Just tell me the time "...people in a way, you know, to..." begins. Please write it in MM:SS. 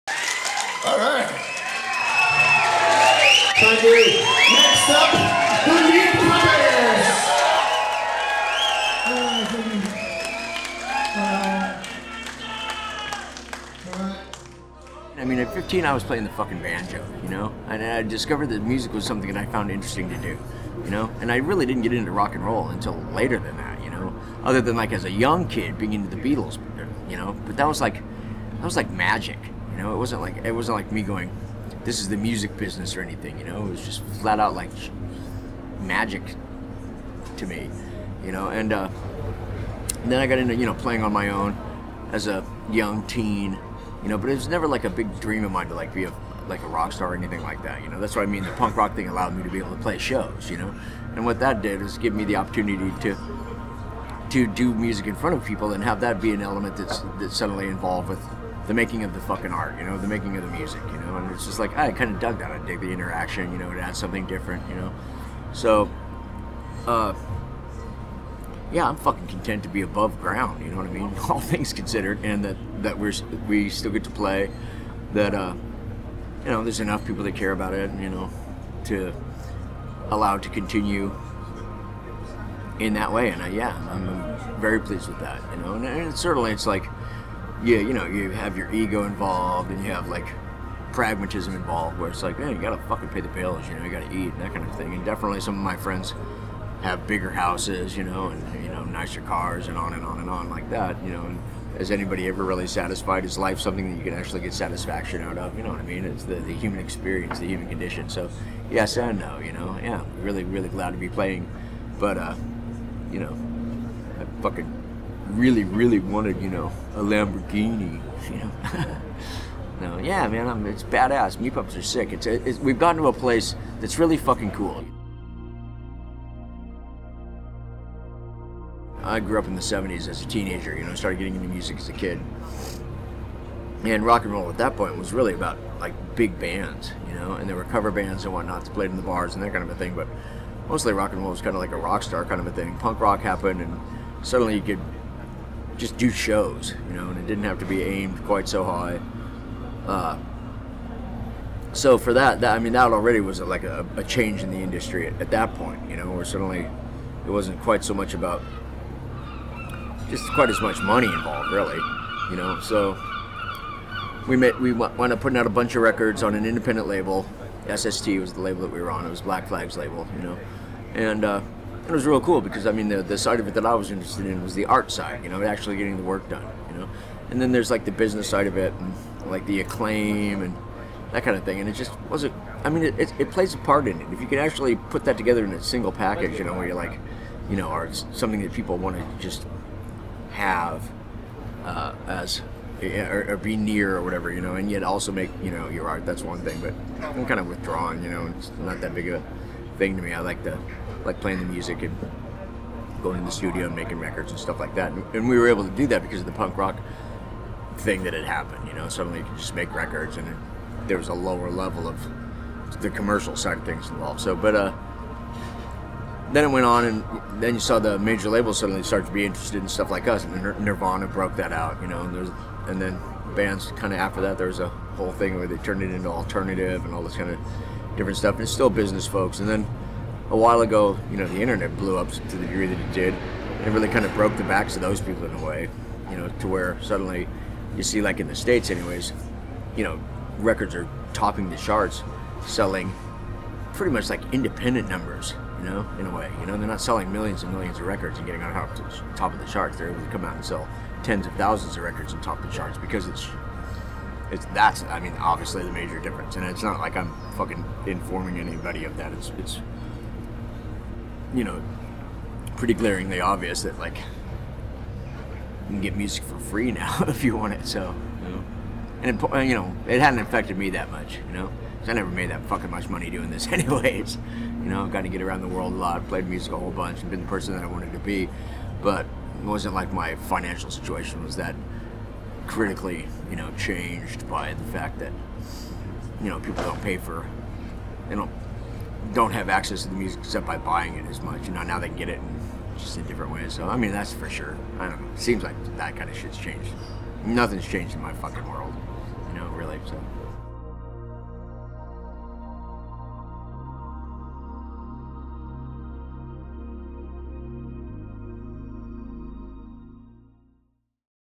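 03:55.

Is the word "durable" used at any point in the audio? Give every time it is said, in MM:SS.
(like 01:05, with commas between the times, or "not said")
not said.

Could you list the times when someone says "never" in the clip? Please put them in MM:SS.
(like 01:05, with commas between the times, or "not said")
00:44, 04:31.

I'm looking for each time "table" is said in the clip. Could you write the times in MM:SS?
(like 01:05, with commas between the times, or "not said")
not said.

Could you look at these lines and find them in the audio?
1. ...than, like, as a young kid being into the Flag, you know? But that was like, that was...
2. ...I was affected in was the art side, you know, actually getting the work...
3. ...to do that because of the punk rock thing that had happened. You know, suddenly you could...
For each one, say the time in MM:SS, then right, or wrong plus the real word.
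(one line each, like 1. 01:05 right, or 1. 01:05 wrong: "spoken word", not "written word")
1. 00:24 wrong: "Beatles", not "Flag"
2. 02:53 wrong: "interested", not "affected"
3. 03:25 right.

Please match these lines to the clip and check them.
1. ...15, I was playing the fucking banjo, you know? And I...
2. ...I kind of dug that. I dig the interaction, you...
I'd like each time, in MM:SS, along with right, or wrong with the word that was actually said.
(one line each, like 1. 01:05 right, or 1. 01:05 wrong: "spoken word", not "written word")
1. 00:15 right
2. 01:01 right.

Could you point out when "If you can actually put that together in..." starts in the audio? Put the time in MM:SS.
03:04.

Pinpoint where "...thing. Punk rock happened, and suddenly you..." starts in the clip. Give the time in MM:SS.
02:22.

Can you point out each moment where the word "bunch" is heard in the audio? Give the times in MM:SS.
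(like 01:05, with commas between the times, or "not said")
02:45, 04:36.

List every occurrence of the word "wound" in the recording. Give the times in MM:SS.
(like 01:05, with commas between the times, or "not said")
02:44.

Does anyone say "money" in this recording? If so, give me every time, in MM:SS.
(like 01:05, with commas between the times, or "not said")
02:40, 04:32.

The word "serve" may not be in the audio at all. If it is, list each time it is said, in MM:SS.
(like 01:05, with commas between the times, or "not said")
not said.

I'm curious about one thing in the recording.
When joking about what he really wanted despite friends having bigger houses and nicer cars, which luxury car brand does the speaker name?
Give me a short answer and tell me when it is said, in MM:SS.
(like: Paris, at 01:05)
Lamborghini, at 01:57.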